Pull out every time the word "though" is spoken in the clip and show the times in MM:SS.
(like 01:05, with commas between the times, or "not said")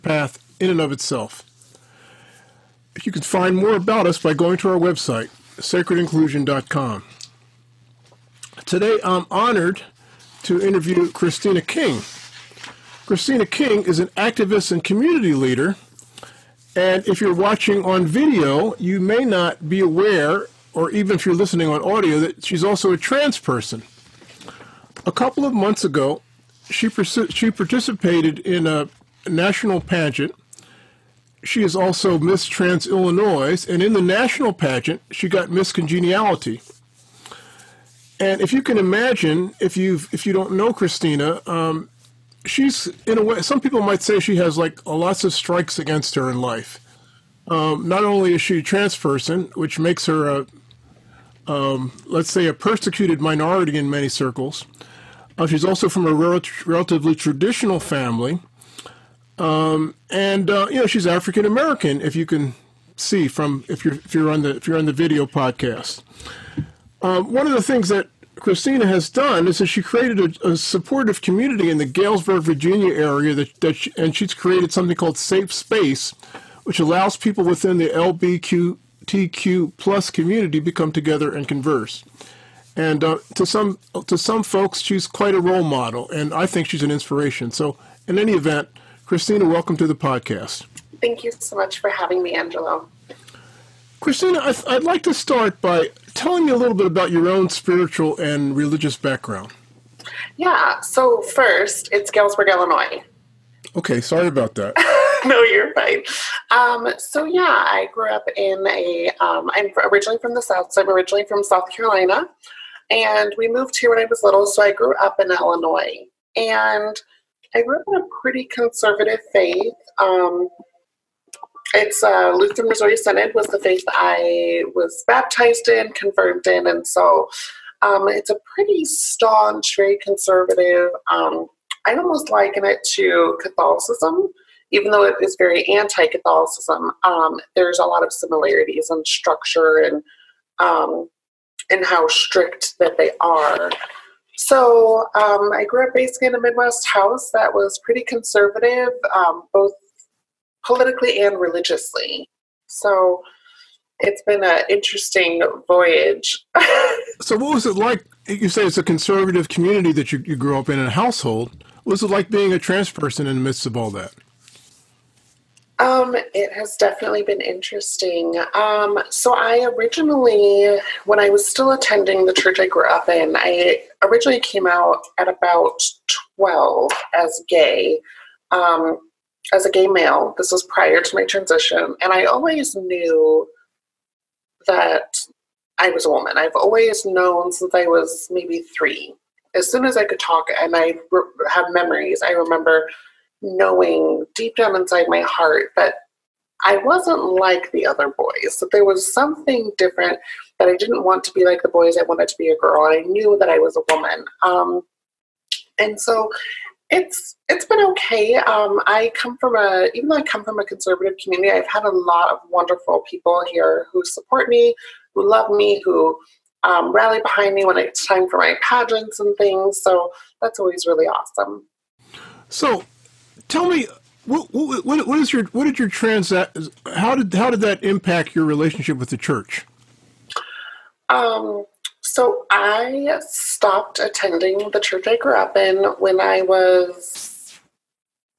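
02:14, 03:30.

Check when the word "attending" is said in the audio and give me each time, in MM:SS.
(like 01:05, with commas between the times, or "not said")
02:51, 03:53.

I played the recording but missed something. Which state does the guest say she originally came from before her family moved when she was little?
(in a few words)
South Carolina.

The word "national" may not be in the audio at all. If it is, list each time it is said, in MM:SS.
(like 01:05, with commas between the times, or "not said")
00:29, 00:34.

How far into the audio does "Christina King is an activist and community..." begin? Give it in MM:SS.
00:13.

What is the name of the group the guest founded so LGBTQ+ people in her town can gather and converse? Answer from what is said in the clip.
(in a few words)
Safe Space.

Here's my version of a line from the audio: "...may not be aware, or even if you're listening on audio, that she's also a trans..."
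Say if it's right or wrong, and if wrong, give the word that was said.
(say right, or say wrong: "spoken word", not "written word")
right.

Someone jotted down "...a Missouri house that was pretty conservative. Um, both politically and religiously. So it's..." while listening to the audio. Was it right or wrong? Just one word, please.
wrong.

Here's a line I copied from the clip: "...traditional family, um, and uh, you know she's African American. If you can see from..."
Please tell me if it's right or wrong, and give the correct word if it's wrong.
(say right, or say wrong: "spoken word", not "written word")
right.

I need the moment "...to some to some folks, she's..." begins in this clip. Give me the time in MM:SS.
01:23.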